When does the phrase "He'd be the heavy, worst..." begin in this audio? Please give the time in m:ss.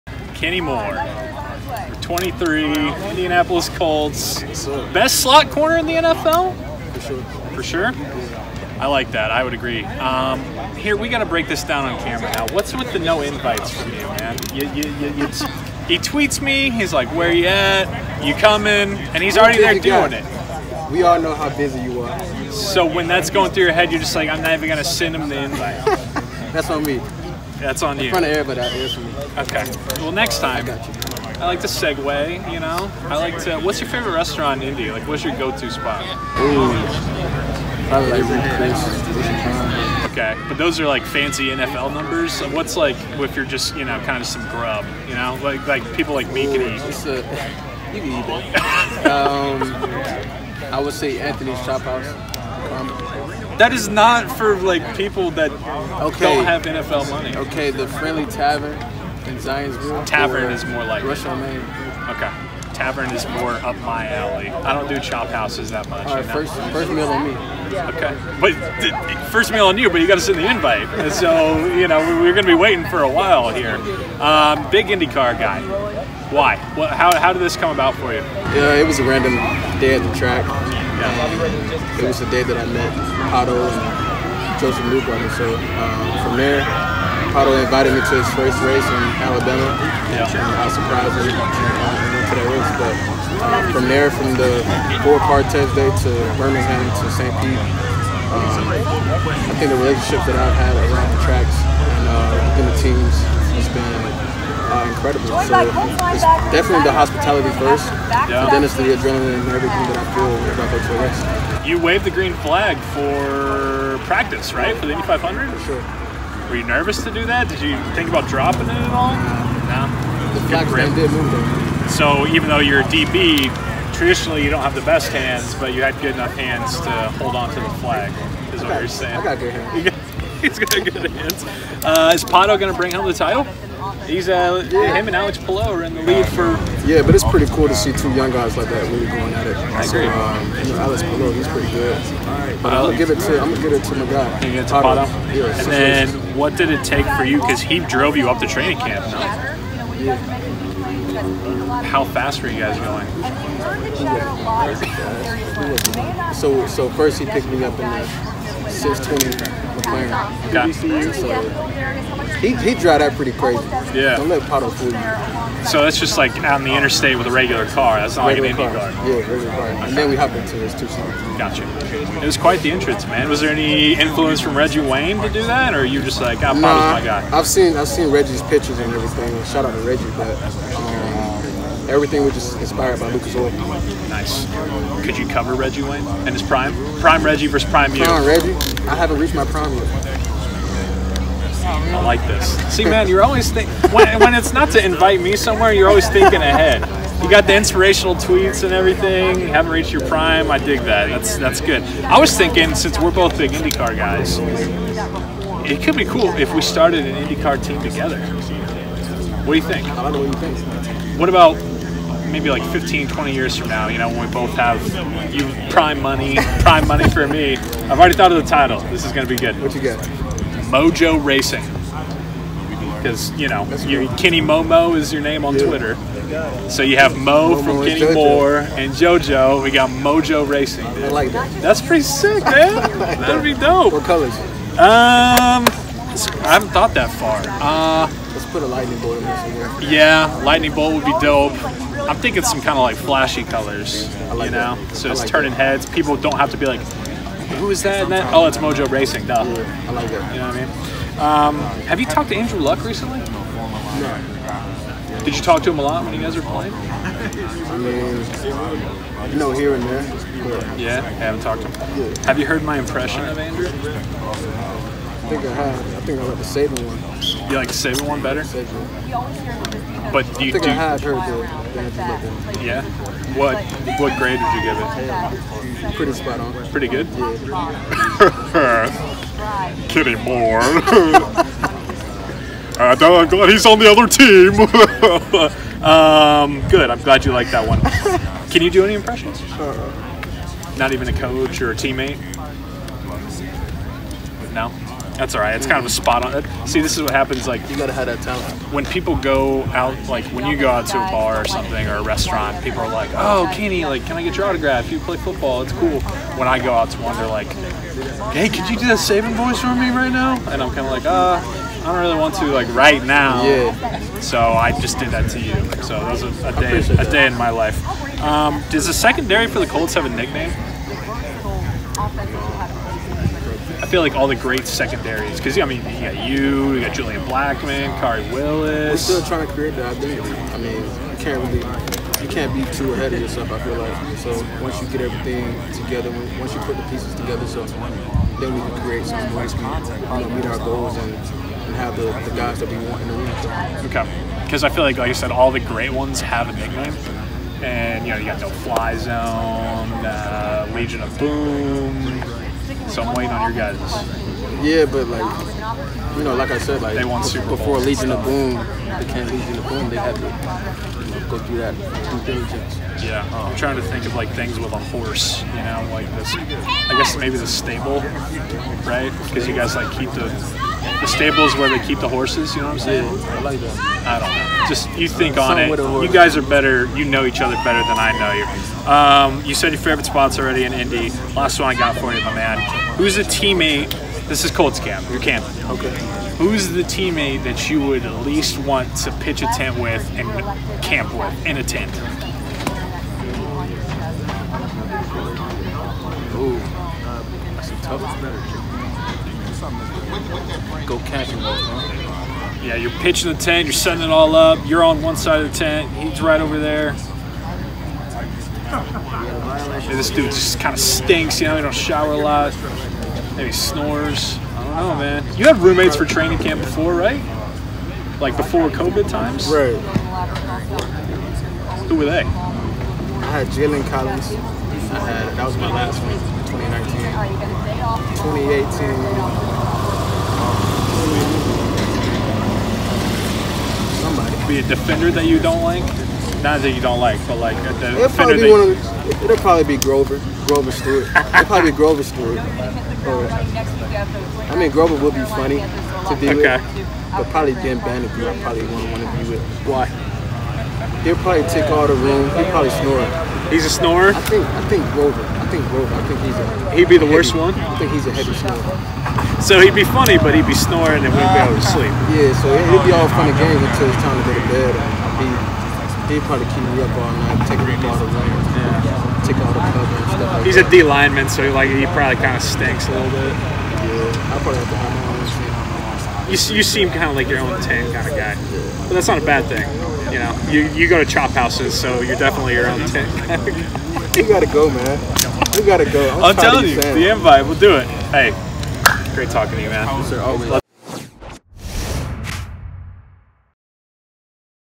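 7:36.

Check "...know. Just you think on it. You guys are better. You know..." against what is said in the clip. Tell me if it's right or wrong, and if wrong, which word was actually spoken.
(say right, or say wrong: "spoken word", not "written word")
right.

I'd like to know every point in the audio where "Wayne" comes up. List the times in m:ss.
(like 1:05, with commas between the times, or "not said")
2:54, 3:05.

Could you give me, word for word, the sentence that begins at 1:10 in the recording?
And so you know we're going to be waiting for a while here.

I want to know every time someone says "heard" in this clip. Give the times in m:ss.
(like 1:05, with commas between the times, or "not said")
4:22, 4:31.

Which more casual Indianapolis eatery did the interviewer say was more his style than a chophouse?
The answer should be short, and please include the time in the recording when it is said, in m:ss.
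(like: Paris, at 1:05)
The Friendly Tavern, at 0:57.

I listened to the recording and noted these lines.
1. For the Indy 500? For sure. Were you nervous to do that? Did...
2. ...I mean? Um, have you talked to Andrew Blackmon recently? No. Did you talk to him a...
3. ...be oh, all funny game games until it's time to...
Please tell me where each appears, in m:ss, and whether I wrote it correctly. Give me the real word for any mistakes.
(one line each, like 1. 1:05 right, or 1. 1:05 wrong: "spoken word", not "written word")
1. 1:54 right
2. 4:10 wrong: "Luck", not "Blackmon"
3. 7:42 right.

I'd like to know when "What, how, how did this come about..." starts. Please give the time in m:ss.
1:16.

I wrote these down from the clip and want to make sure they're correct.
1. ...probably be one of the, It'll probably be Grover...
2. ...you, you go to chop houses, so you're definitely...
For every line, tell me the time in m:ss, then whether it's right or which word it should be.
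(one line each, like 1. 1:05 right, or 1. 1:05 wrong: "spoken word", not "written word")
1. 7:18 right
2. 8:00 right.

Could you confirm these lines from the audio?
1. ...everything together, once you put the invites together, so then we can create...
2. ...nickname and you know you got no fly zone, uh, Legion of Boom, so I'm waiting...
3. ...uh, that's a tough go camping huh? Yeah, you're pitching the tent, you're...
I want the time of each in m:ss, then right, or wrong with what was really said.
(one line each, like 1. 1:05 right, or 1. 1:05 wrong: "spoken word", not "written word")
1. 5:35 wrong: "pieces", not "invites"
2. 5:46 right
3. 6:36 right.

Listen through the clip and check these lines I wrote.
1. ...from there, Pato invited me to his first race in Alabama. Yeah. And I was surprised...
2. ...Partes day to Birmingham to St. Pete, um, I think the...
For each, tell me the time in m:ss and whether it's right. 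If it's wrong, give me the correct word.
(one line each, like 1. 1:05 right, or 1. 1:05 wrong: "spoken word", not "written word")
1. 1:26 right
2. 1:35 right.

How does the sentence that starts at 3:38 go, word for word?
This is going to be good.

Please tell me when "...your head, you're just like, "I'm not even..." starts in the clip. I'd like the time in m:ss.
0:23.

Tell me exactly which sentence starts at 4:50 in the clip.
Not even a coach or a teammate.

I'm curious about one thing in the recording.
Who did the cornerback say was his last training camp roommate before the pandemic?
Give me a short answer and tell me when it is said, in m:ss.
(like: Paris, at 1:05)
Jalen Collins, at 7:03.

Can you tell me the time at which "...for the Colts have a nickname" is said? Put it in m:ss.
5:19.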